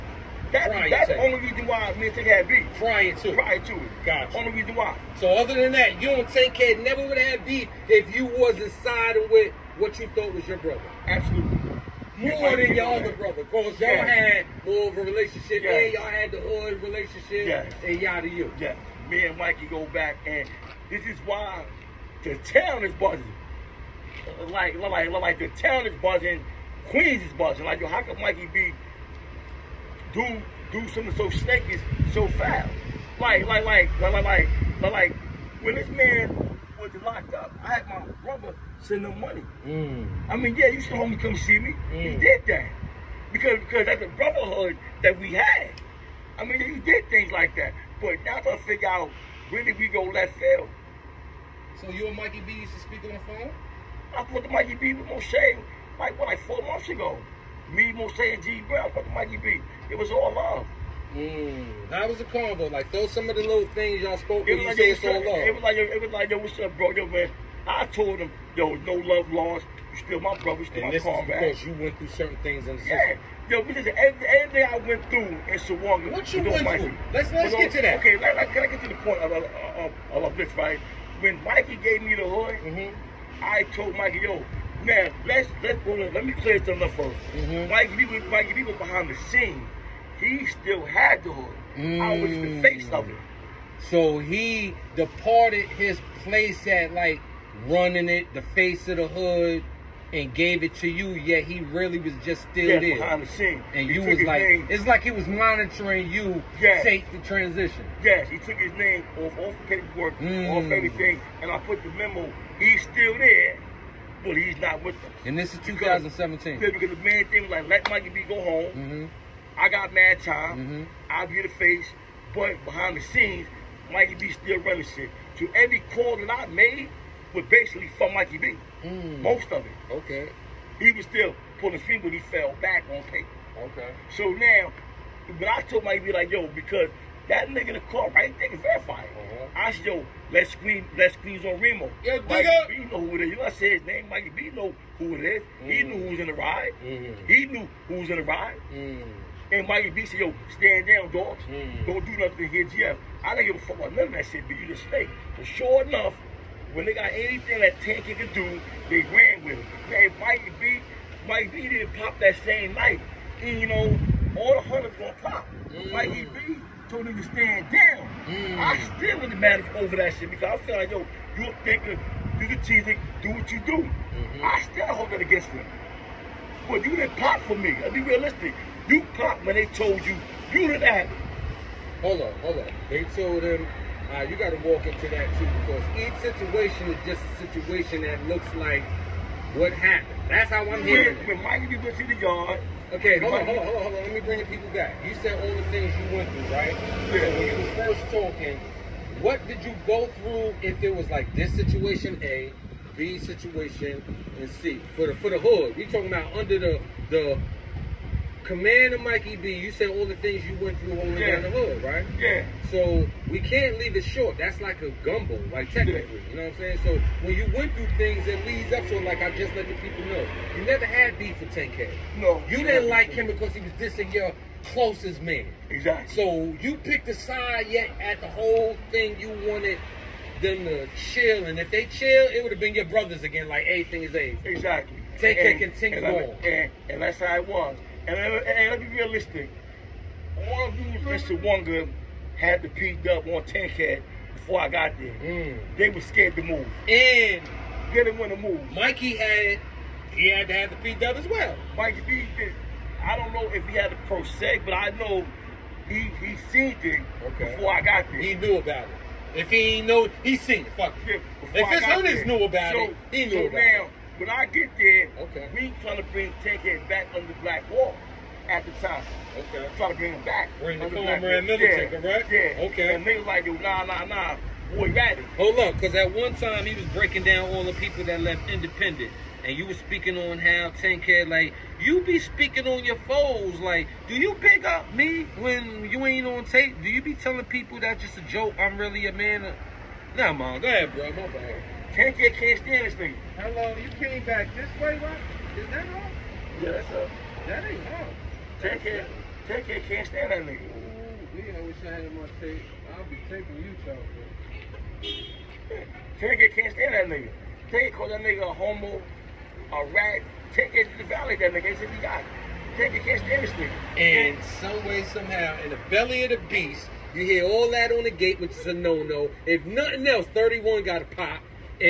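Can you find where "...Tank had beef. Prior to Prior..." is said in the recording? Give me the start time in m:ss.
0:02.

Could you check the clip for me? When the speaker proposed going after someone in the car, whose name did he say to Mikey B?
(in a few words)
Remo.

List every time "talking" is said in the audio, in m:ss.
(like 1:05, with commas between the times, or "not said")
3:18, 3:25.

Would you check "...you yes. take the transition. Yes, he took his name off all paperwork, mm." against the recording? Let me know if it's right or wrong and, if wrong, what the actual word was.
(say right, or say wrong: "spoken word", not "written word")
right.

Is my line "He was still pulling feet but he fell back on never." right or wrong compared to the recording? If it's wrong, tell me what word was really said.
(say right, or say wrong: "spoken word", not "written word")
wrong: "paper", not "never".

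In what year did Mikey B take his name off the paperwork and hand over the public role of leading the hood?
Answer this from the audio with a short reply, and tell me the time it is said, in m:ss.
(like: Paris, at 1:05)
2017, at 1:55.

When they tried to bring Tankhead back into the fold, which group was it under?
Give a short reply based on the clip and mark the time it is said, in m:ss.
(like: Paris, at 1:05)
Black Wall, at 4:27.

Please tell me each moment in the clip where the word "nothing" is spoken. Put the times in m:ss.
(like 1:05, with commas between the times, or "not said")
2:32, 5:19.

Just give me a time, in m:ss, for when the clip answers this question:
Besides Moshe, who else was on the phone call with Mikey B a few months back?
0:58.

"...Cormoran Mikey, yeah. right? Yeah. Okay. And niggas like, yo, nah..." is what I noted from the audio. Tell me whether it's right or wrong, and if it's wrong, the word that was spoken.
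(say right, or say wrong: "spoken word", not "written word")
wrong: "Middleton", not "Mikey".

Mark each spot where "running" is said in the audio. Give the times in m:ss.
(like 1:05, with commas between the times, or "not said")
1:37, 2:04.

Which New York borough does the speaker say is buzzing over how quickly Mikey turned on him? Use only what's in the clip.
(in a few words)
Queens.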